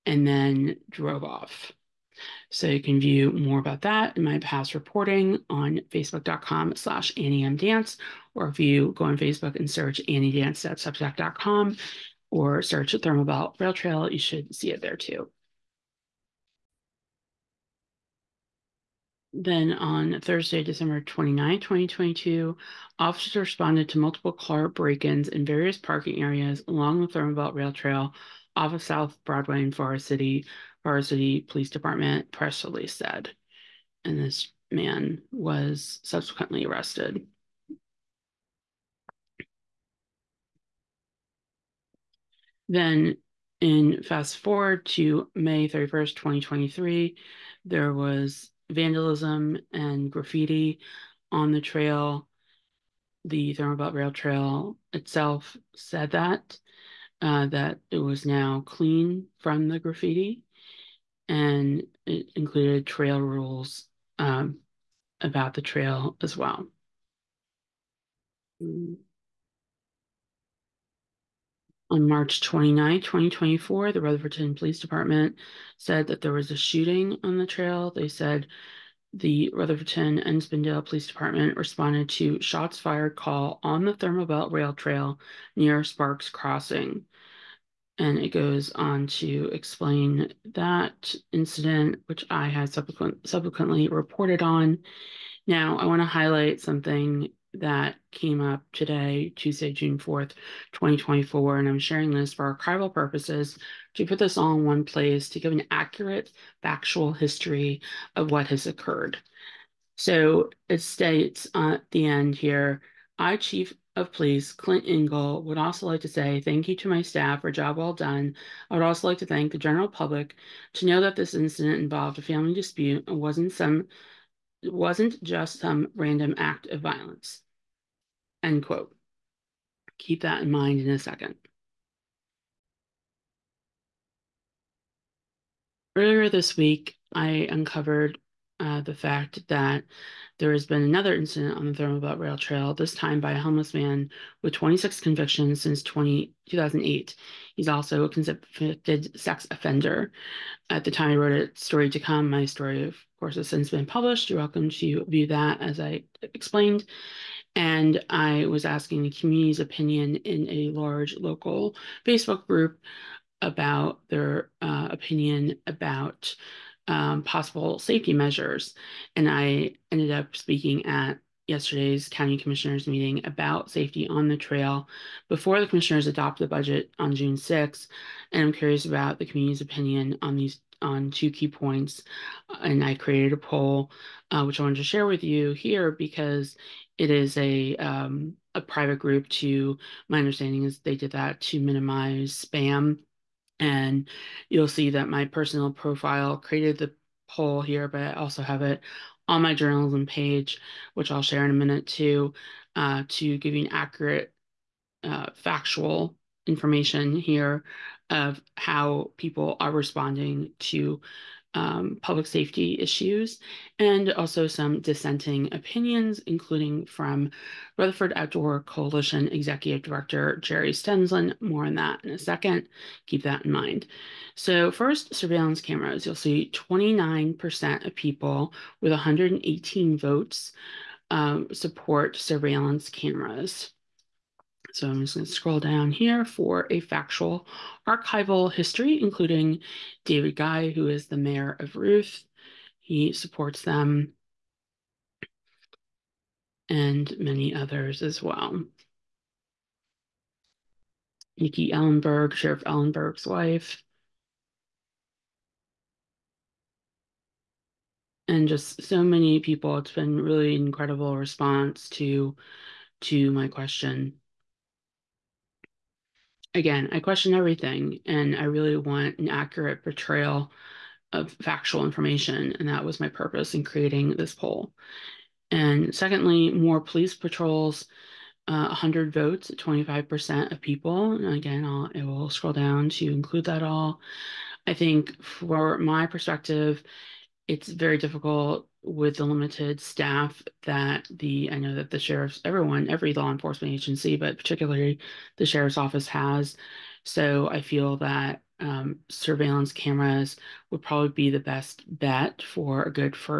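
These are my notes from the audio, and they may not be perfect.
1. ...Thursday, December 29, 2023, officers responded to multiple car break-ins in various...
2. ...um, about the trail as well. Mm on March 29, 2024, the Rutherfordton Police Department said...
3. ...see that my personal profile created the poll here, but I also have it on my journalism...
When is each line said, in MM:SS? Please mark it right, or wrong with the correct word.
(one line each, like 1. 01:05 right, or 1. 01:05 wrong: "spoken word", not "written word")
1. 00:20 wrong: "2022", not "2023"
2. 01:04 right
3. 03:14 right.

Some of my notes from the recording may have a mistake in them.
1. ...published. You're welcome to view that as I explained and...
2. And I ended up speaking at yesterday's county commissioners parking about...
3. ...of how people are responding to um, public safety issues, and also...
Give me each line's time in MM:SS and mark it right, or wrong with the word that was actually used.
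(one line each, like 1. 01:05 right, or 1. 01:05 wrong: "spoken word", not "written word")
1. 02:33 right
2. 02:49 wrong: "meeting", not "parking"
3. 03:28 right.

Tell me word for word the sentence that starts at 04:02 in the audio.
He supports them and many others as well.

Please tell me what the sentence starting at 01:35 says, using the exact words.
Now, I want to highlight something that came up today, Tuesday, June 4th, 2024.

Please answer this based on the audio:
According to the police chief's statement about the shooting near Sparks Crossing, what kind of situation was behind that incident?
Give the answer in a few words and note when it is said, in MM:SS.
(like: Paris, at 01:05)
family dispute, at 02:02.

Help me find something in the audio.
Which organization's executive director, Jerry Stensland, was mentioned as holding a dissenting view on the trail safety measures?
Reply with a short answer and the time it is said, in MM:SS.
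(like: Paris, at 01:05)
Rutherford Outdoor Coalition, at 03:37.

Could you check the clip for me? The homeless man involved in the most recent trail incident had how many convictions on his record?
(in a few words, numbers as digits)
26.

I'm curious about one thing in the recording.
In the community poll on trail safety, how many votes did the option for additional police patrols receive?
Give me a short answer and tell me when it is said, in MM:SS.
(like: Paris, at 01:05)
100, at 04:38.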